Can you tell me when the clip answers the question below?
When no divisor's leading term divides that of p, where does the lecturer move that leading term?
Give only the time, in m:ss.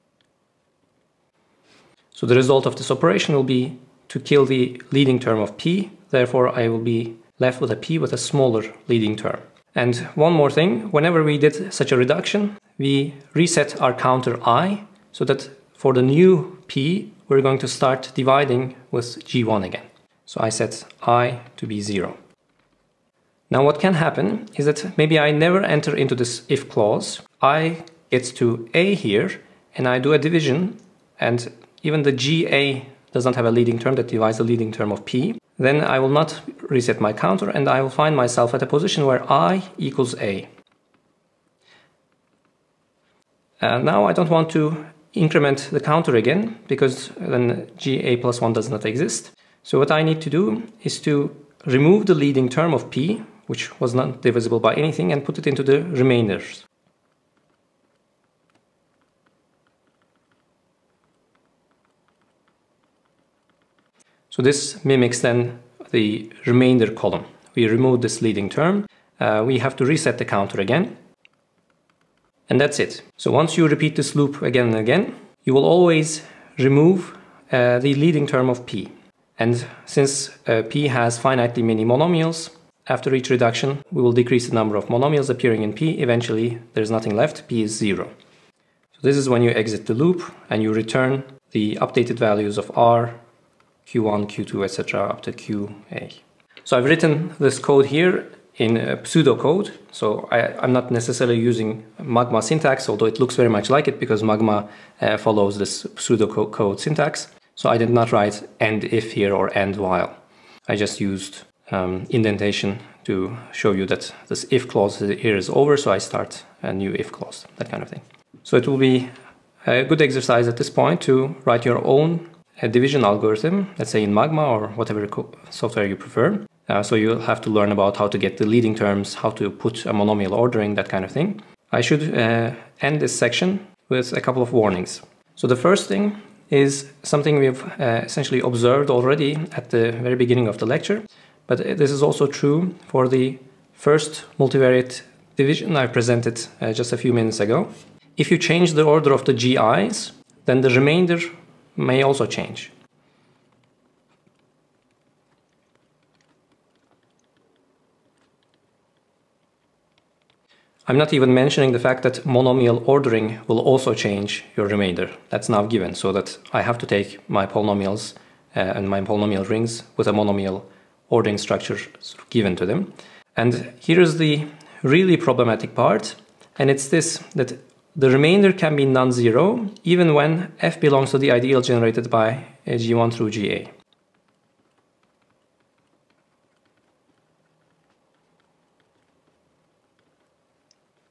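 0:55.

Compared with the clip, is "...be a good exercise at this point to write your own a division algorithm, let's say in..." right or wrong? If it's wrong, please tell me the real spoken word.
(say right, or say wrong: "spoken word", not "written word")
right.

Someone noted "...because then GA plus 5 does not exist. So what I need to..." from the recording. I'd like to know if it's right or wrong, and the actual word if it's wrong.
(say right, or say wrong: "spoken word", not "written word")
wrong: "1", not "5".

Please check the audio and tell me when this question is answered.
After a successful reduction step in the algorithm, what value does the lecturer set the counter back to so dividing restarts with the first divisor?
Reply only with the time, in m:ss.
0:21.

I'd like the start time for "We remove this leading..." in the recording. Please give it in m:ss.
1:07.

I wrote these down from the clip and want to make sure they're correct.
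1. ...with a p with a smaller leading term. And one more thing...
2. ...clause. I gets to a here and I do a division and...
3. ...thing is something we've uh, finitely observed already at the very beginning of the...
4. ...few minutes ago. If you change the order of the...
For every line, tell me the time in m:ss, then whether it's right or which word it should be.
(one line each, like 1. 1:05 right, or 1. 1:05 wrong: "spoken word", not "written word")
1. 0:07 right
2. 0:26 right
3. 2:15 wrong: "essentially", not "finitely"
4. 2:26 right.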